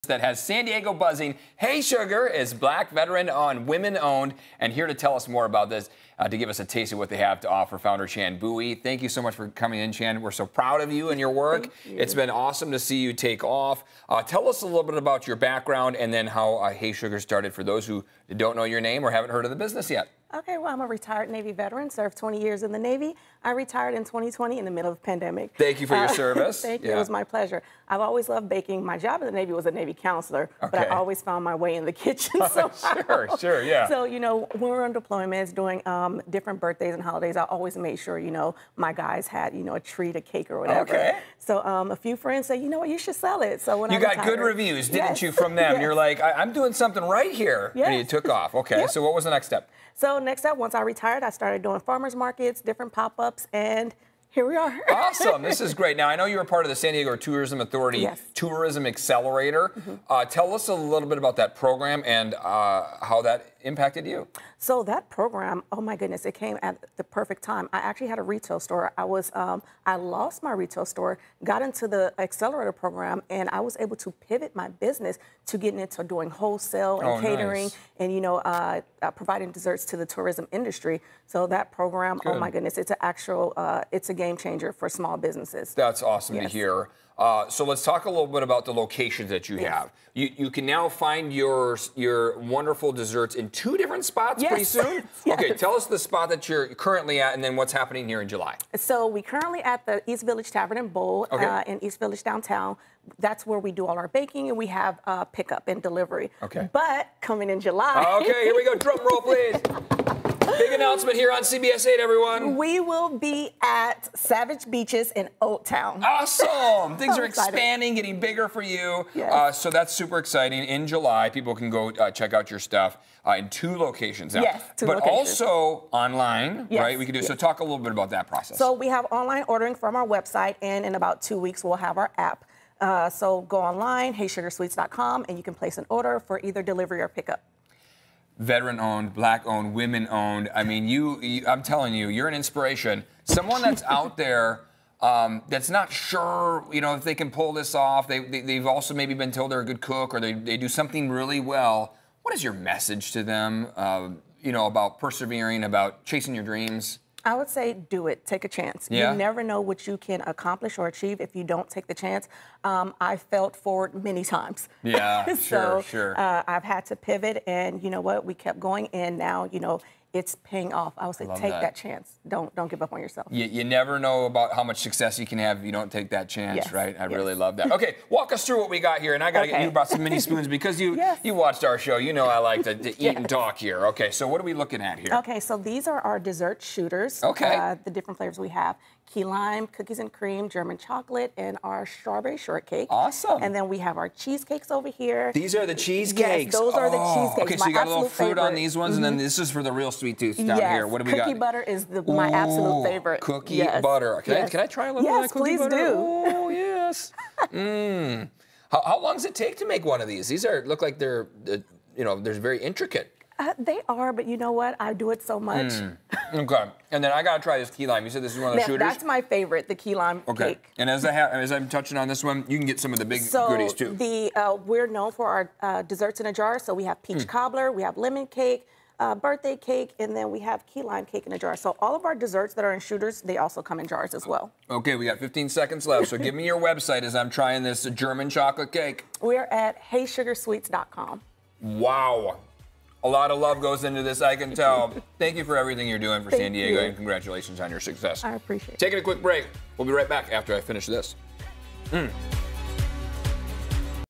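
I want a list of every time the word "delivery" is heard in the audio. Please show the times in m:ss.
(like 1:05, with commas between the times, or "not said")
1:45, 2:16.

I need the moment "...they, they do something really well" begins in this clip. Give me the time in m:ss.
2:30.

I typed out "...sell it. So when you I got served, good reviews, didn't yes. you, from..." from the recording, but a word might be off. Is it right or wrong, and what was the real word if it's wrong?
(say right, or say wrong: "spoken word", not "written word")
wrong: "retired", not "served".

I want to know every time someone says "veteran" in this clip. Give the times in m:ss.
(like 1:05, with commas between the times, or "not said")
0:02, 0:21, 2:18.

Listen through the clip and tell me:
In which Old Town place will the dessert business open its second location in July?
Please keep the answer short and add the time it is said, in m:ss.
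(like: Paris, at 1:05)
Savage Beaches, at 1:54.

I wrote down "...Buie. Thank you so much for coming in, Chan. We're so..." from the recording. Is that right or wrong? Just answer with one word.
right.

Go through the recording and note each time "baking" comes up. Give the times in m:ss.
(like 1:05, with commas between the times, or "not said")
0:28, 1:44.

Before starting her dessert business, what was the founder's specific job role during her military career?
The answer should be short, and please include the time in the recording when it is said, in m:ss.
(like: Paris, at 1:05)
Navy counselor, at 0:29.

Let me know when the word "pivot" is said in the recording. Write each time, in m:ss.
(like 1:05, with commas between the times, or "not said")
1:14, 2:46.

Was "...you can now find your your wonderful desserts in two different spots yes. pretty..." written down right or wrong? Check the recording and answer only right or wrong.
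right.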